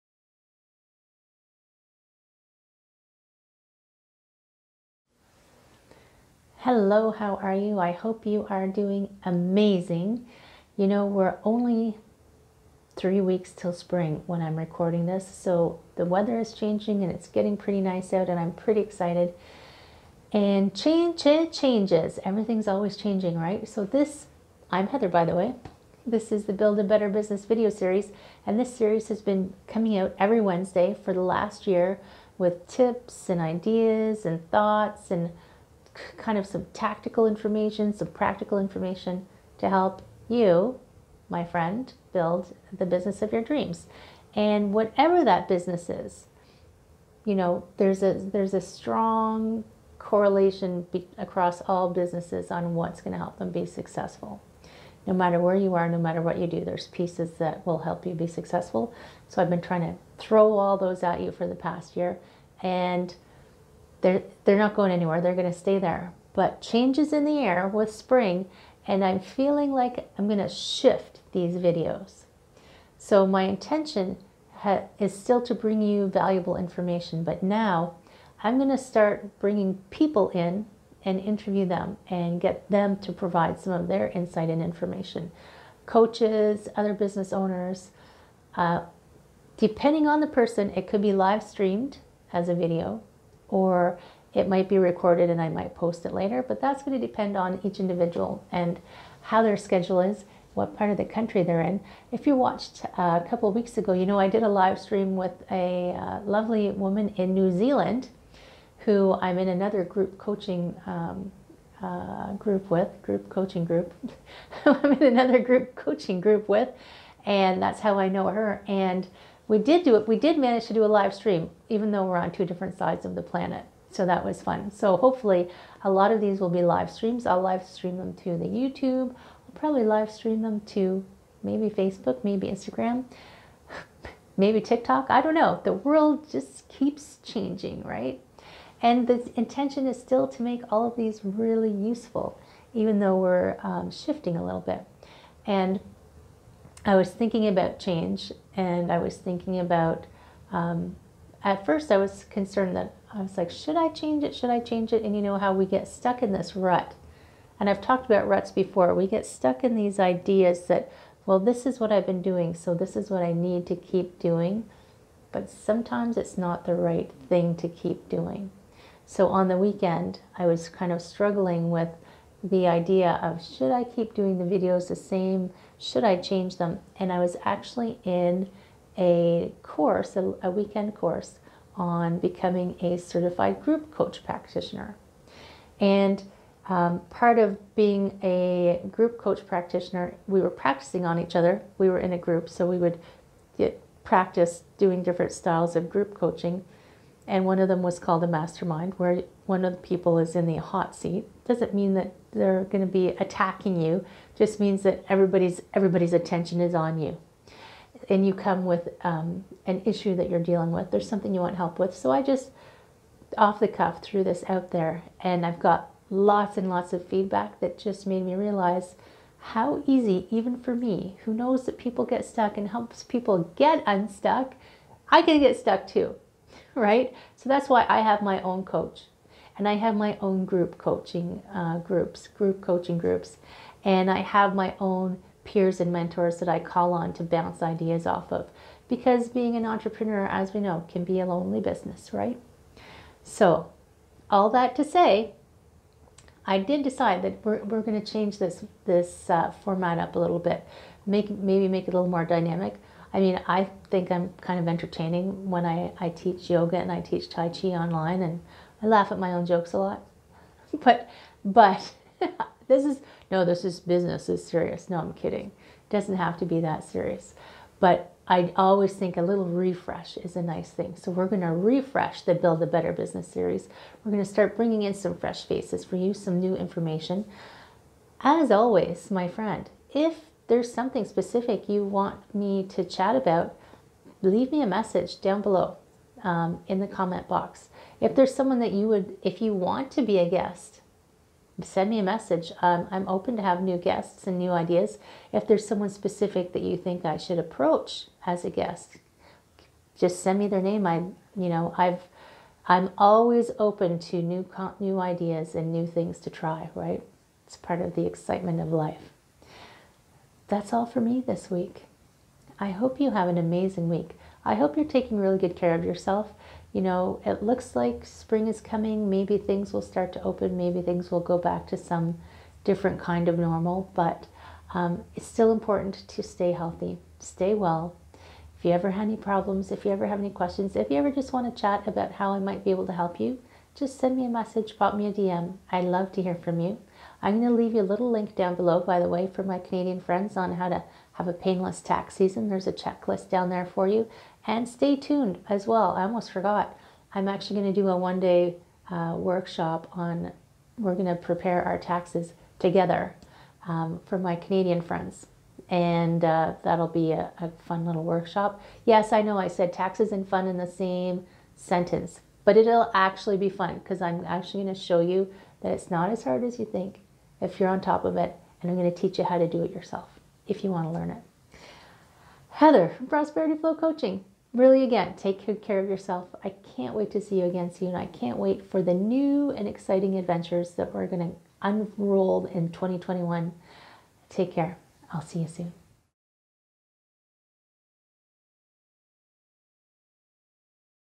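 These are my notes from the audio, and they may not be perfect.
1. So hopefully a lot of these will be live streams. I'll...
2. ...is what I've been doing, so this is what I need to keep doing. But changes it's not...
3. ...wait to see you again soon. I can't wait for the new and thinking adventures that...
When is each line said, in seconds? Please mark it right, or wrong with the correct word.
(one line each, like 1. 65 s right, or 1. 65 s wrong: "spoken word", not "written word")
1. 124 s right
2. 161 s wrong: "sometimes", not "changes"
3. 376 s wrong: "exciting", not "thinking".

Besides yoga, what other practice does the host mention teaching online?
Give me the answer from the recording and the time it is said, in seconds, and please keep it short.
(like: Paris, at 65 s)
Tai Chi, at 257 s.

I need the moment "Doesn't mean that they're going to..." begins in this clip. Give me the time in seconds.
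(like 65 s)
201 s.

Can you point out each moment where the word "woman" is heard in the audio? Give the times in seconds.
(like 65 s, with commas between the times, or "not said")
106 s.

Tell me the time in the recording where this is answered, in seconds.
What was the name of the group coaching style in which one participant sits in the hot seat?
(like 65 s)
198 s.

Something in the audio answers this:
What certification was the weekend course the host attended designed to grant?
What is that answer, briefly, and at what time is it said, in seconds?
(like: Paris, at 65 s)
Certified group coach practitioner, at 182 s.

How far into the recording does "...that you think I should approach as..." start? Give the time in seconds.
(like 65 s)
296 s.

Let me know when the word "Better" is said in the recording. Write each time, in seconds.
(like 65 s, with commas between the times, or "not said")
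26 s, 272 s.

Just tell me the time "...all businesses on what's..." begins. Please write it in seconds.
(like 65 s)
51 s.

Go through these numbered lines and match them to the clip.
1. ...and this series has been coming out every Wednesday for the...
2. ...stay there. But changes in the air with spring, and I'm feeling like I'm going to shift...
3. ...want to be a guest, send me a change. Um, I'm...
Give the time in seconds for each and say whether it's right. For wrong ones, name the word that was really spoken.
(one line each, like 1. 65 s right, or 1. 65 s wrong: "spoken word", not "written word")
1. 28 s right
2. 65 s right
3. 289 s wrong: "message", not "change".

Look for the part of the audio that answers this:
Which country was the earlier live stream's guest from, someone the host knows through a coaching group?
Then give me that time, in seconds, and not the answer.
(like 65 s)
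107 s.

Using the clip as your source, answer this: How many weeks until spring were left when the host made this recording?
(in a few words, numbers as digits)
3.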